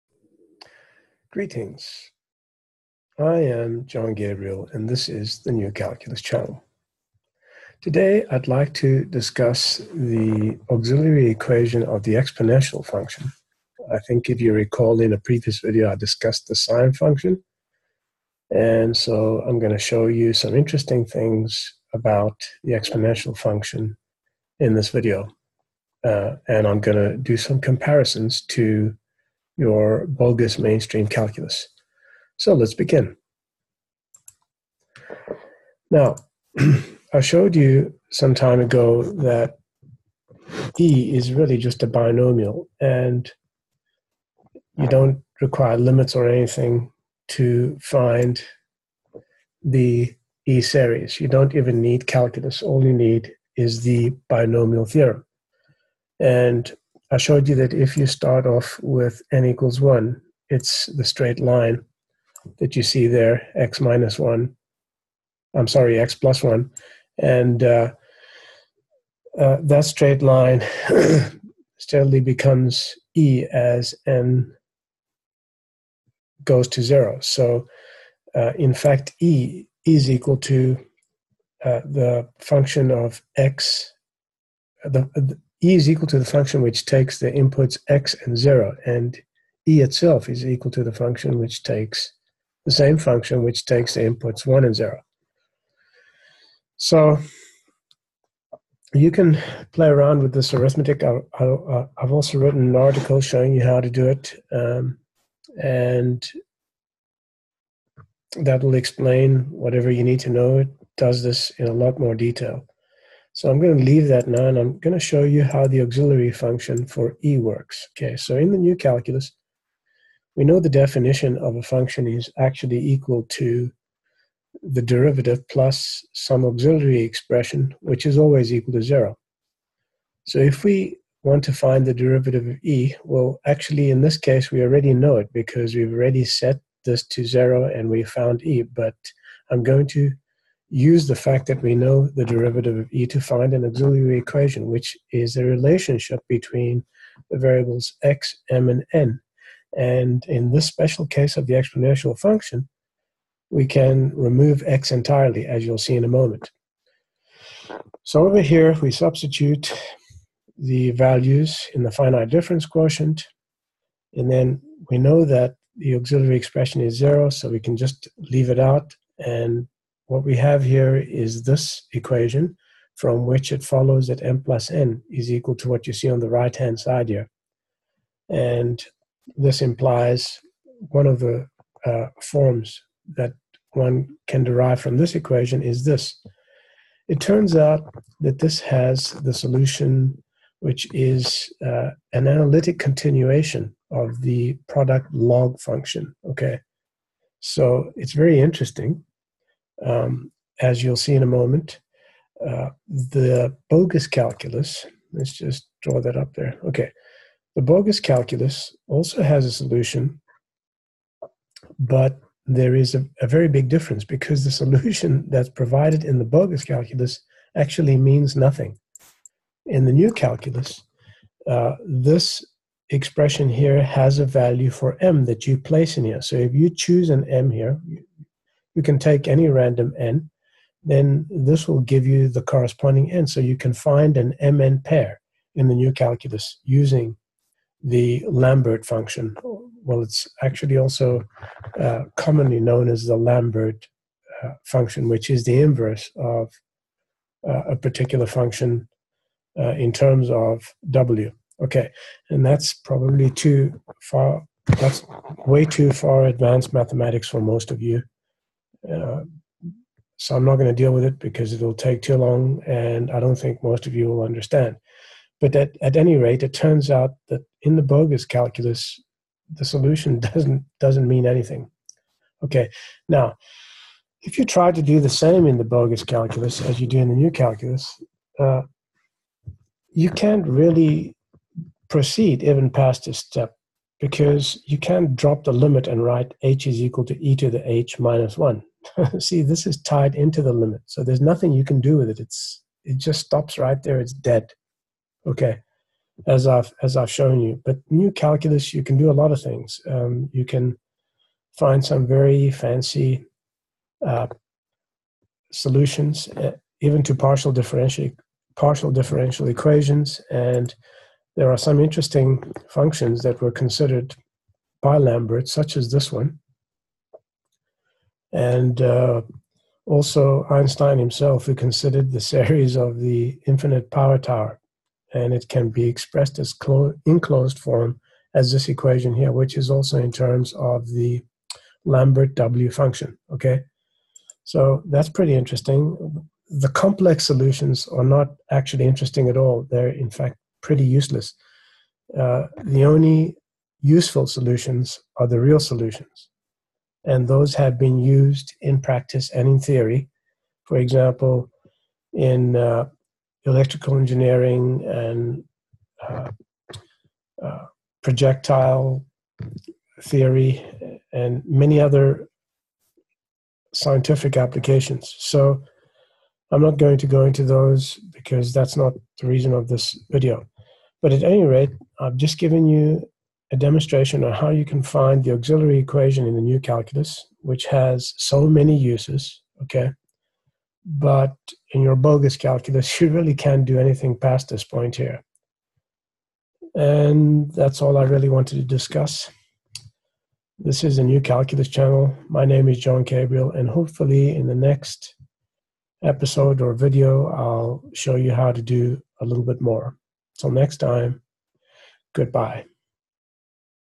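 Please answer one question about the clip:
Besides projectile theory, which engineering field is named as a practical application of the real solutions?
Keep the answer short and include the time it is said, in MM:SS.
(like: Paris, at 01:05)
electrical engineering, at 05:53.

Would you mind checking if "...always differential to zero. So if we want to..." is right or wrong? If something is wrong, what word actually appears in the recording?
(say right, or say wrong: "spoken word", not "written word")
wrong: "equal", not "differential".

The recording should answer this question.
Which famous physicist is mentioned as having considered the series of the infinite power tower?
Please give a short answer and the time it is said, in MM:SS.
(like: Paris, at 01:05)
Einstein, at 05:20.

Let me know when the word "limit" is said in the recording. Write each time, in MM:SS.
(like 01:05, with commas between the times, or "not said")
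00:45, 04:45, 04:50.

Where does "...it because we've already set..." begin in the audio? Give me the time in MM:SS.
02:15.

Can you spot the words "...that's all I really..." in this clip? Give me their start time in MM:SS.
06:27.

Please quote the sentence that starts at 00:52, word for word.
All you need is the binomial theorem.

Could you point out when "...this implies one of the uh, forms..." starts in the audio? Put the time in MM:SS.
02:59.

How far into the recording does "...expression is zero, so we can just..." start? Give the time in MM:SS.
02:46.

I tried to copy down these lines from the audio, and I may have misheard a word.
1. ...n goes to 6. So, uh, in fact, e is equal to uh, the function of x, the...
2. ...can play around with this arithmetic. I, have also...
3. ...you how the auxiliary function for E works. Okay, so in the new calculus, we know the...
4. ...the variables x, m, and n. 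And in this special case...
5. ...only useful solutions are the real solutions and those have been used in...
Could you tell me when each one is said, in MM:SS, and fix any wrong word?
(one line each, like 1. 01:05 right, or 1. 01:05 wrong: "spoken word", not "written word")
1. 01:14 wrong: "0", not "6"
2. 01:39 right
3. 01:55 right
4. 02:27 right
5. 05:42 right.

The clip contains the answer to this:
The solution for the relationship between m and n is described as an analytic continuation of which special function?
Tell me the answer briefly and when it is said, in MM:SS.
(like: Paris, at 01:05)
the product log function, at 03:14.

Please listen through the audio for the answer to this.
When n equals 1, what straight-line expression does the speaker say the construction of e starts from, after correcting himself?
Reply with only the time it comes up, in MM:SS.
01:05.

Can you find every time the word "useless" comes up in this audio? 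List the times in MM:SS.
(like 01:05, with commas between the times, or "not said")
05:40.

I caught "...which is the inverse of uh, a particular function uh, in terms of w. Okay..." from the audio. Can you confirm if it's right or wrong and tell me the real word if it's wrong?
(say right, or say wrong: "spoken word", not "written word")
right.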